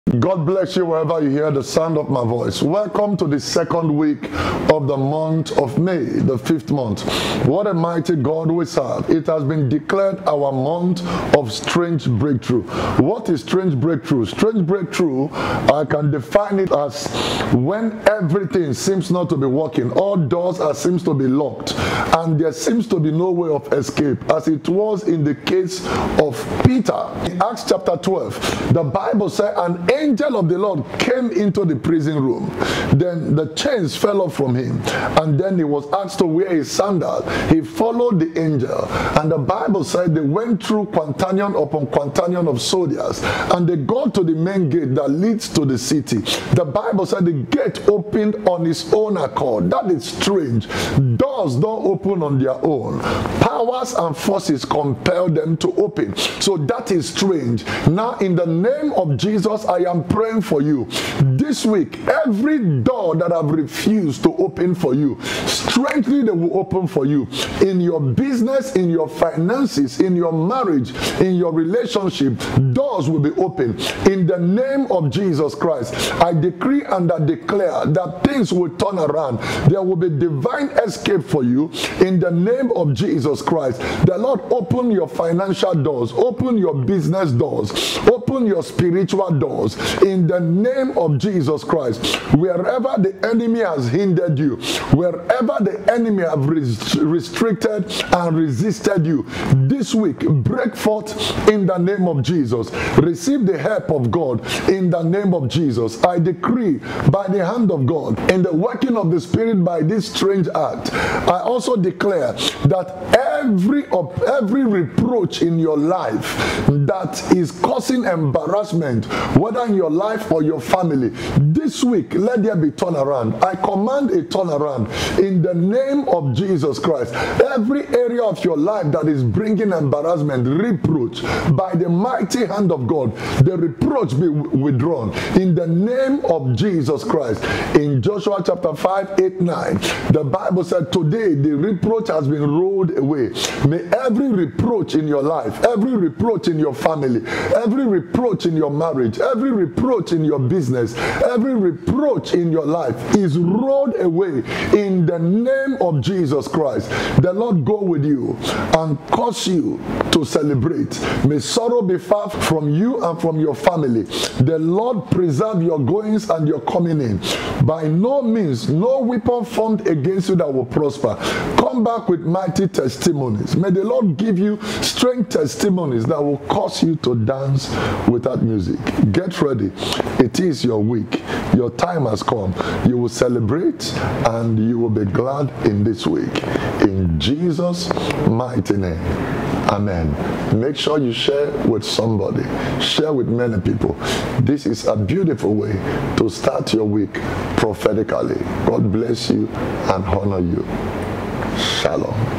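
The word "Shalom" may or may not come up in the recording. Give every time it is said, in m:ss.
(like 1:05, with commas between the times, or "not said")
3:21.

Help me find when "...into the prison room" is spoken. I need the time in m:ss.
0:31.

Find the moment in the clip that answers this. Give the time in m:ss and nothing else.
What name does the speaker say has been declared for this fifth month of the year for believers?
0:10.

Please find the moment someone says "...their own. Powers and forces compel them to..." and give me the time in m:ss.
0:52.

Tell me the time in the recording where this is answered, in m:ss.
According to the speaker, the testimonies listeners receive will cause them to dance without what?
2:58.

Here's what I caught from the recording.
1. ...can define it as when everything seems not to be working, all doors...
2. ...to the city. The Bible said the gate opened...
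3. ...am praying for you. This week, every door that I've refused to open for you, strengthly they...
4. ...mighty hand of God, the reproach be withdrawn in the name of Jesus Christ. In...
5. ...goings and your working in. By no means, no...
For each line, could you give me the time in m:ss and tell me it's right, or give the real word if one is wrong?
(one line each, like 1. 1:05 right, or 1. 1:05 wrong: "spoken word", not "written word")
1. 0:15 right
2. 0:45 right
3. 0:59 right
4. 2:11 right
5. 2:45 wrong: "coming", not "working".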